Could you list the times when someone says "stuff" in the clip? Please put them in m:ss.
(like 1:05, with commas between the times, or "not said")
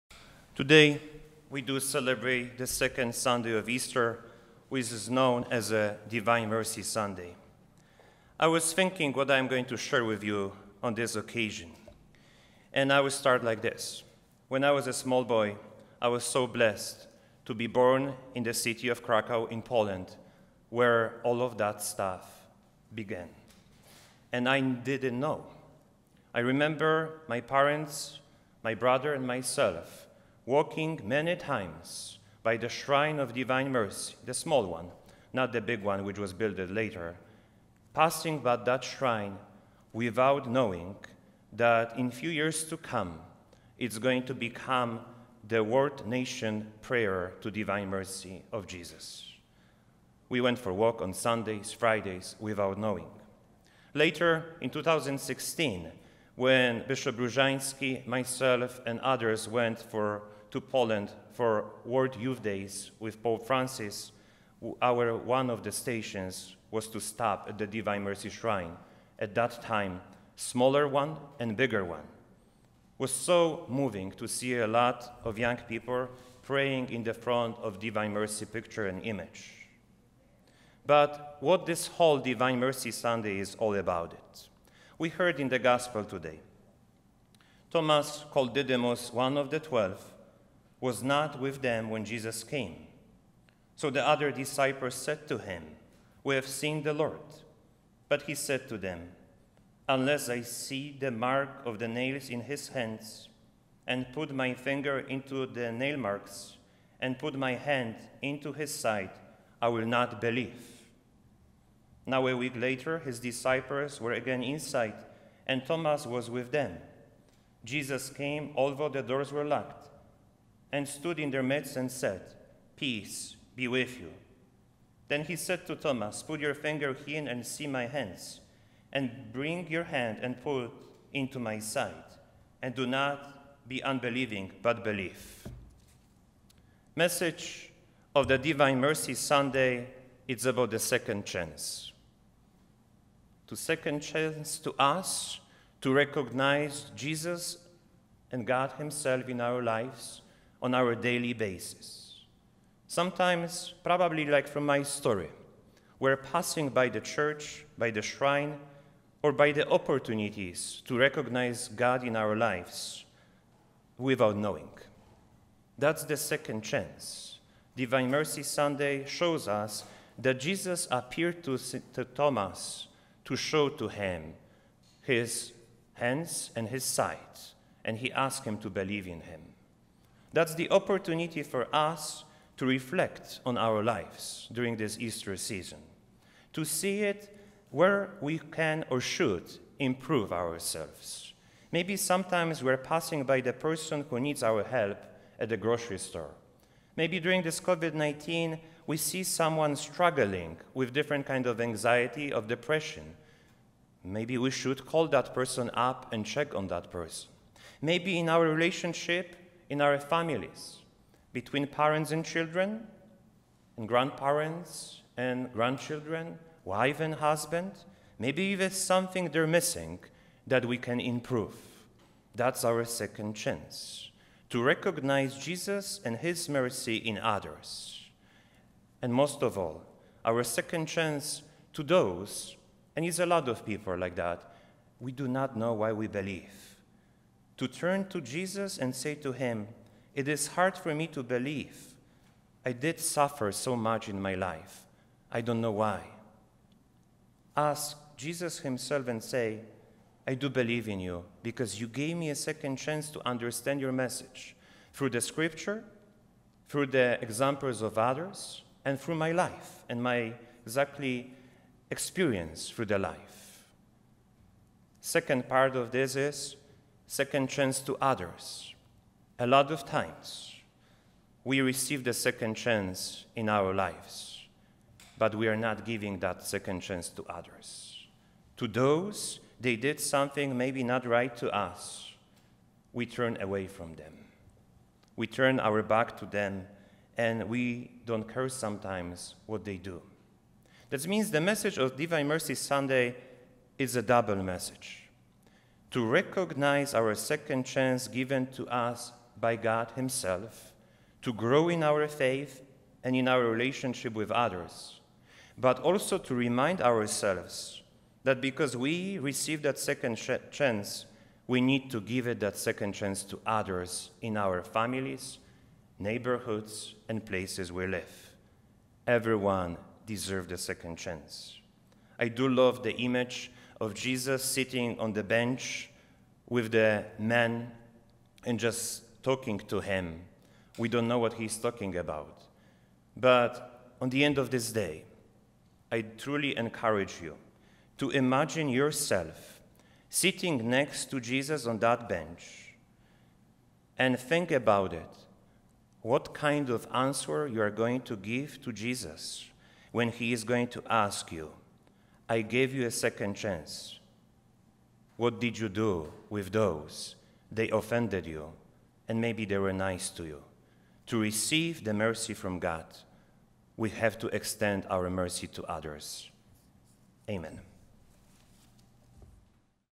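0:21.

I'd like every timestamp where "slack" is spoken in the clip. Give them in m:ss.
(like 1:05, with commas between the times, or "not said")
not said.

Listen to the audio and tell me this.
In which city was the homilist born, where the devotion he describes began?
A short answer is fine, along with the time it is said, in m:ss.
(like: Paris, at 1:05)
Krakow, at 0:19.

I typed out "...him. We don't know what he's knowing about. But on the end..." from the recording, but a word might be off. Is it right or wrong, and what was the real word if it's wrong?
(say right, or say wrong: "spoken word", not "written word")
wrong: "talking", not "knowing".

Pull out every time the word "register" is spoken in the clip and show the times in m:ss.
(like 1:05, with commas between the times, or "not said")
not said.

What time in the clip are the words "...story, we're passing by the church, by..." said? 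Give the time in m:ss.
2:34.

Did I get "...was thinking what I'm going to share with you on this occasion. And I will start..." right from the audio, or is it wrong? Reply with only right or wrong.
right.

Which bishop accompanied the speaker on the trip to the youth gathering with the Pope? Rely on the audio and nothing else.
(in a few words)
Bishop Rozanski.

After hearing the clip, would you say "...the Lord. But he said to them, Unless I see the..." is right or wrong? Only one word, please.
right.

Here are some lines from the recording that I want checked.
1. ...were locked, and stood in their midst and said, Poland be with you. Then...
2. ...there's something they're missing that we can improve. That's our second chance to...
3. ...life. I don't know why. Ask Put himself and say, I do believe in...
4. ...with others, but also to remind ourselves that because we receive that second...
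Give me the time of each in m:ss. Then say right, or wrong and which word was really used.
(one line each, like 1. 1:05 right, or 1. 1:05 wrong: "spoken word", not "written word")
1. 1:59 wrong: "Peace", not "Poland"
2. 3:38 right
3. 4:04 wrong: "Jesus", not "Put"
4. 5:04 right.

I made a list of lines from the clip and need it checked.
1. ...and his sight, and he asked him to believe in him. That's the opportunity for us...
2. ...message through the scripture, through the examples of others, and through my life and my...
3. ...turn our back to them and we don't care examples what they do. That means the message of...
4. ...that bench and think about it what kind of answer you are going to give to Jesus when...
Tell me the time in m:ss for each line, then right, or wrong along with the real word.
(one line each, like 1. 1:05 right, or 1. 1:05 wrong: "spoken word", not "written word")
1. 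2:56 right
2. 4:13 right
3. 4:45 wrong: "sometimes", not "examples"
4. 5:41 right.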